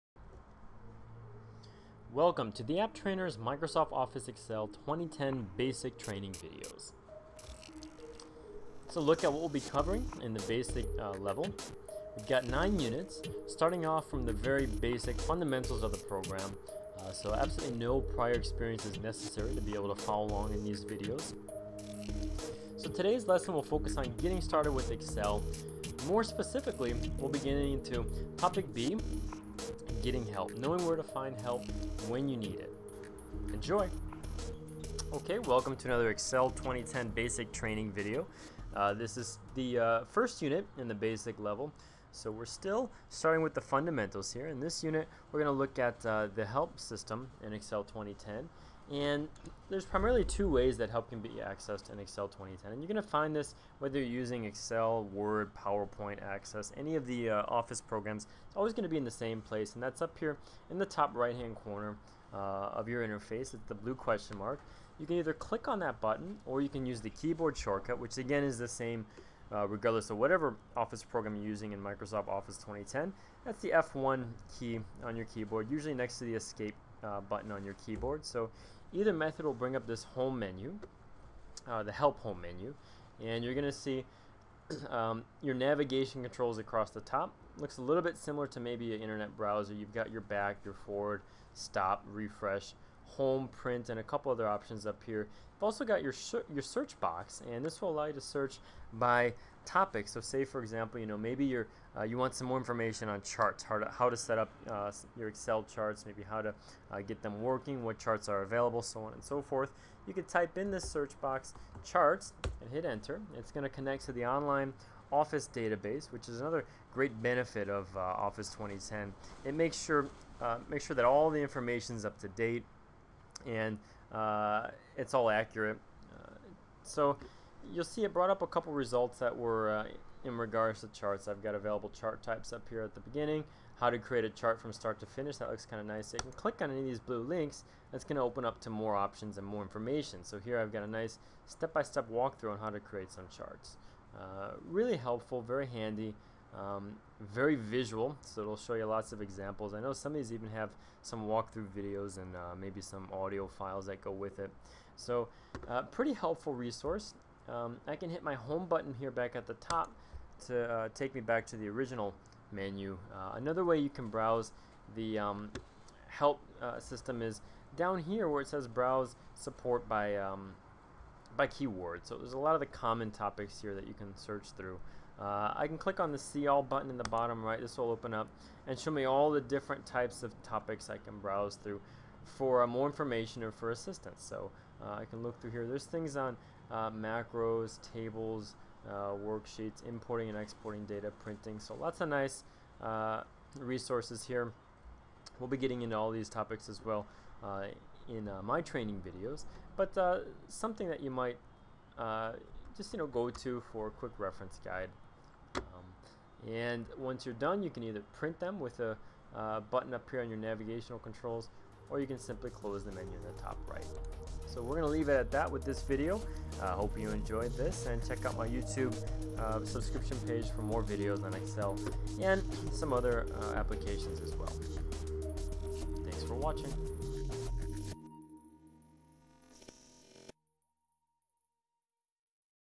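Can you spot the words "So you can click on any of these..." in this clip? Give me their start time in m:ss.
2:16.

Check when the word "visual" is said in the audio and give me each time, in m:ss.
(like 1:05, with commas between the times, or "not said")
2:27.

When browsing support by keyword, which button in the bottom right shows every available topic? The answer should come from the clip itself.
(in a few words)
see all.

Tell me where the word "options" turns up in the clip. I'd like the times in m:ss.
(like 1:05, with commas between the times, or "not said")
1:34, 2:18.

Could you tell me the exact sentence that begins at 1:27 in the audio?
Looks a little bit similar to maybe an internet browser.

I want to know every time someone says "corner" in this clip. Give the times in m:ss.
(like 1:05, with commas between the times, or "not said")
1:01.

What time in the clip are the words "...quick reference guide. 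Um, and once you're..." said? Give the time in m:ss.
3:23.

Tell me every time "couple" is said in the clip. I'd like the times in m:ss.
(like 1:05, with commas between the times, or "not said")
1:34, 2:08.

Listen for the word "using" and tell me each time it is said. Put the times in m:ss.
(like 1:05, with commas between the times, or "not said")
0:54, 1:11.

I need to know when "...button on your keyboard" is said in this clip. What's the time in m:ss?
1:17.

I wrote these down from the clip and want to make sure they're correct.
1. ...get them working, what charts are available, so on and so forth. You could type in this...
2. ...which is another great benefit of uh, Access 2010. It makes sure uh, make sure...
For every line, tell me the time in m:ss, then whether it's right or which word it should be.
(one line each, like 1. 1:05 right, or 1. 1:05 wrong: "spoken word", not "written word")
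1. 1:47 right
2. 1:56 wrong: "Office", not "Access".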